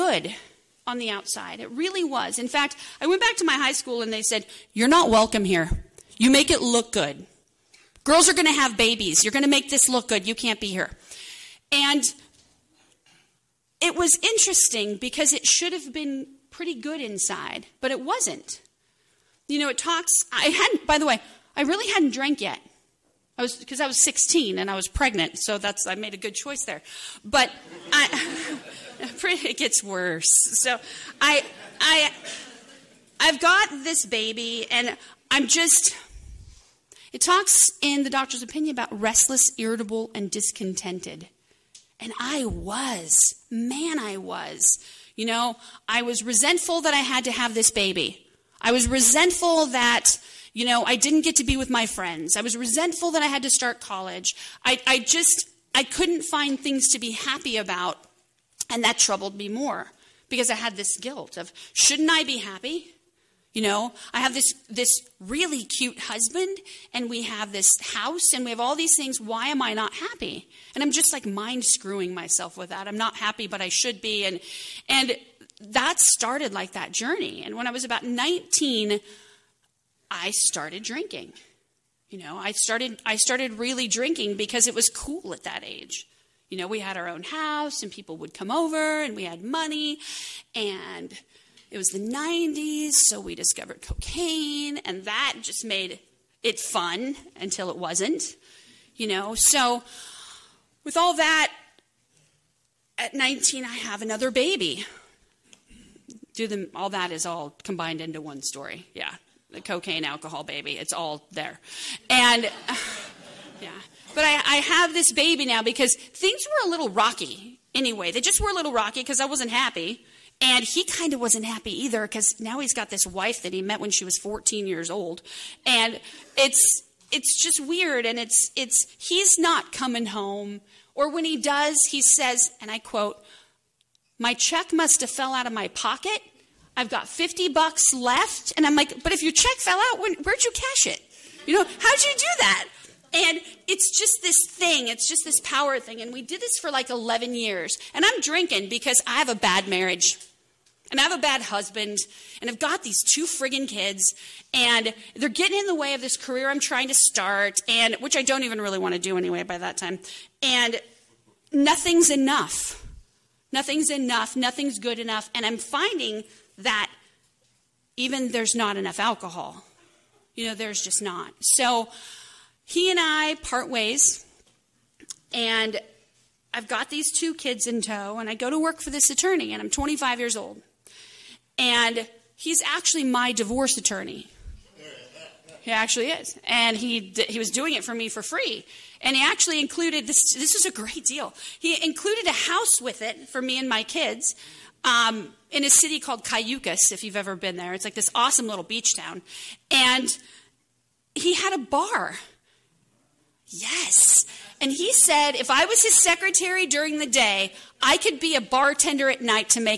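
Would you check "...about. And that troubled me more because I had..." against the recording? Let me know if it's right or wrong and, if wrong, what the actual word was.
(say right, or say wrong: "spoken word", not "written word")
right.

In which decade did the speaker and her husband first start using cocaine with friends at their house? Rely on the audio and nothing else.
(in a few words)
1990s.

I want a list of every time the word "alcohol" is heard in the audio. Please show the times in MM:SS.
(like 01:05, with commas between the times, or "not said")
01:50, 02:48.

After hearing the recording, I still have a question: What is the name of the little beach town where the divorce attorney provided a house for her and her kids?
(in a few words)
Cayucos.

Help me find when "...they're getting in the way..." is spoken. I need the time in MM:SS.
02:35.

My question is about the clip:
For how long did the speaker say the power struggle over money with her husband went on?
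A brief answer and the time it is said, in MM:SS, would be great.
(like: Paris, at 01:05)
11 years, at 02:26.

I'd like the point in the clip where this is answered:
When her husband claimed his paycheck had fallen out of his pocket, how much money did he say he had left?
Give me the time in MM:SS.
02:17.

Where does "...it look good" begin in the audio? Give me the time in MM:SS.
00:06.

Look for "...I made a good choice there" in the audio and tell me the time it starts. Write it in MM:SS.
00:25.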